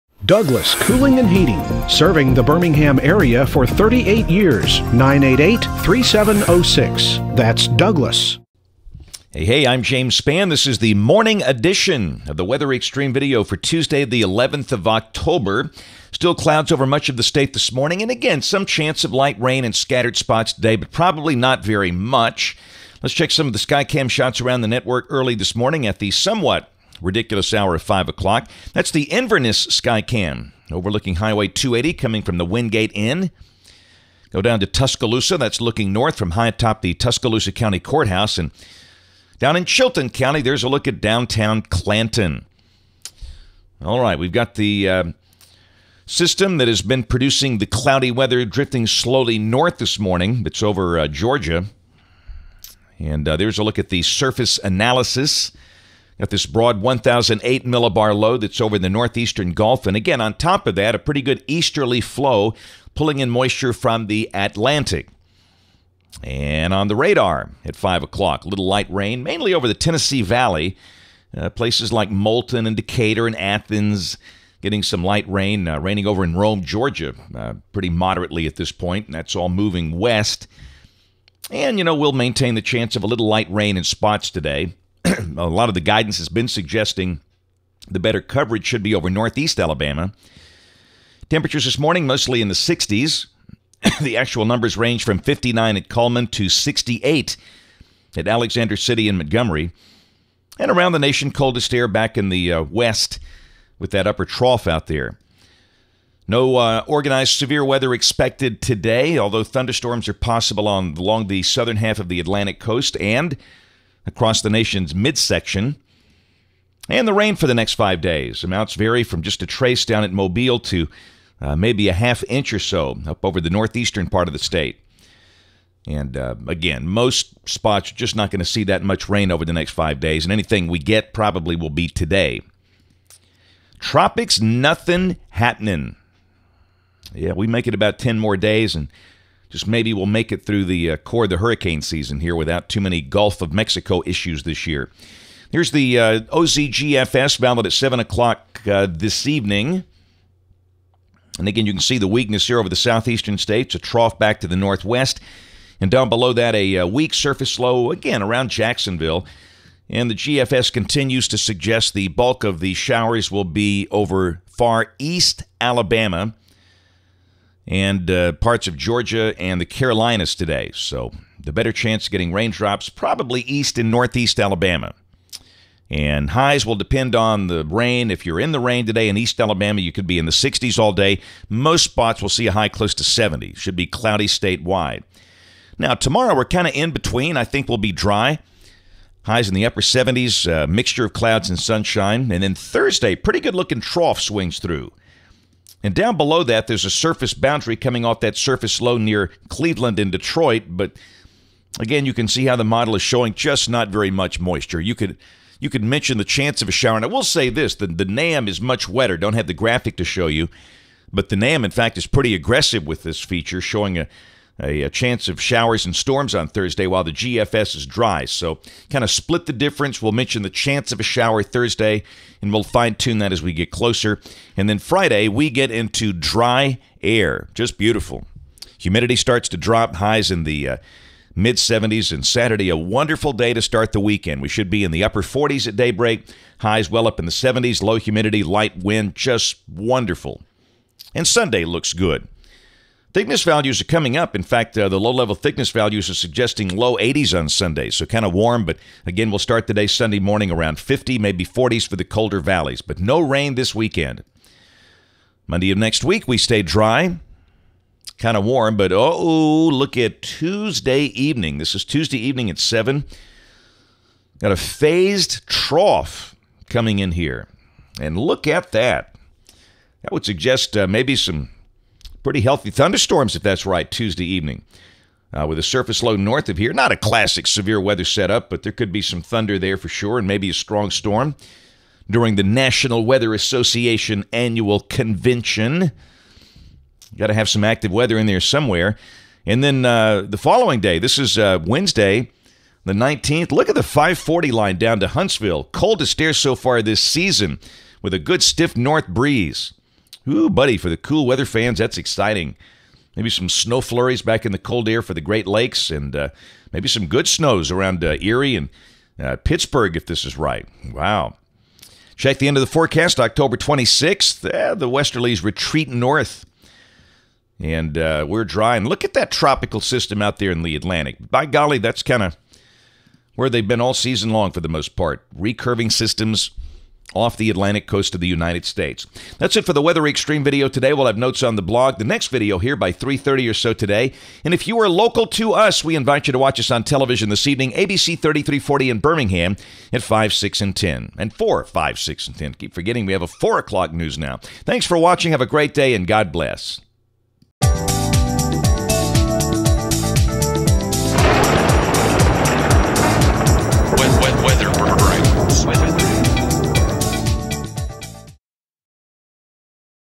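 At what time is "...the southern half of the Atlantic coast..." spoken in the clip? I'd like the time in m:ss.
1:51.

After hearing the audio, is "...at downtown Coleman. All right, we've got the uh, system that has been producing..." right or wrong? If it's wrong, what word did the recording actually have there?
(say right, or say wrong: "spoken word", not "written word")
wrong: "Clanton", not "Coleman".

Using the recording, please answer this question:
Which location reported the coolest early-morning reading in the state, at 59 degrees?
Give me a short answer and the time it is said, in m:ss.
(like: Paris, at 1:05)
Coleman, at 1:35.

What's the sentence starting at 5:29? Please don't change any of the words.
That's it for the Weather Xtreme video today.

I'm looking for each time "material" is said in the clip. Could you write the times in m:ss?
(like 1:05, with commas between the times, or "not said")
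not said.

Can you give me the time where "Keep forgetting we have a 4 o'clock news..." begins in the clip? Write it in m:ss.
5:42.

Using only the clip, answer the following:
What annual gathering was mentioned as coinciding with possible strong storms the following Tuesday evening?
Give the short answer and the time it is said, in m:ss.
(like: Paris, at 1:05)
National Weather Association annual convention, at 4:42.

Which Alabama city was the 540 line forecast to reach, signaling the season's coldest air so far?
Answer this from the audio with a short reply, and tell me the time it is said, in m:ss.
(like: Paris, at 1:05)
Huntsville, at 4:55.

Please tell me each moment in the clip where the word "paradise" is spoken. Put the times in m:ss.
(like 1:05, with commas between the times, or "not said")
not said.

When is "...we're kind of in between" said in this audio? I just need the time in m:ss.
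3:06.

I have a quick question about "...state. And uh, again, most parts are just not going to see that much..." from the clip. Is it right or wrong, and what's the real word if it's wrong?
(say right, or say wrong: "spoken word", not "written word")
wrong: "spots", not "parts".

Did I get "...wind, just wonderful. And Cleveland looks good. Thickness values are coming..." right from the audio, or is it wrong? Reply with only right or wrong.
wrong.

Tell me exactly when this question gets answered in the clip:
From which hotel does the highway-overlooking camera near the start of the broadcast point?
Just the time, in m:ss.
0:32.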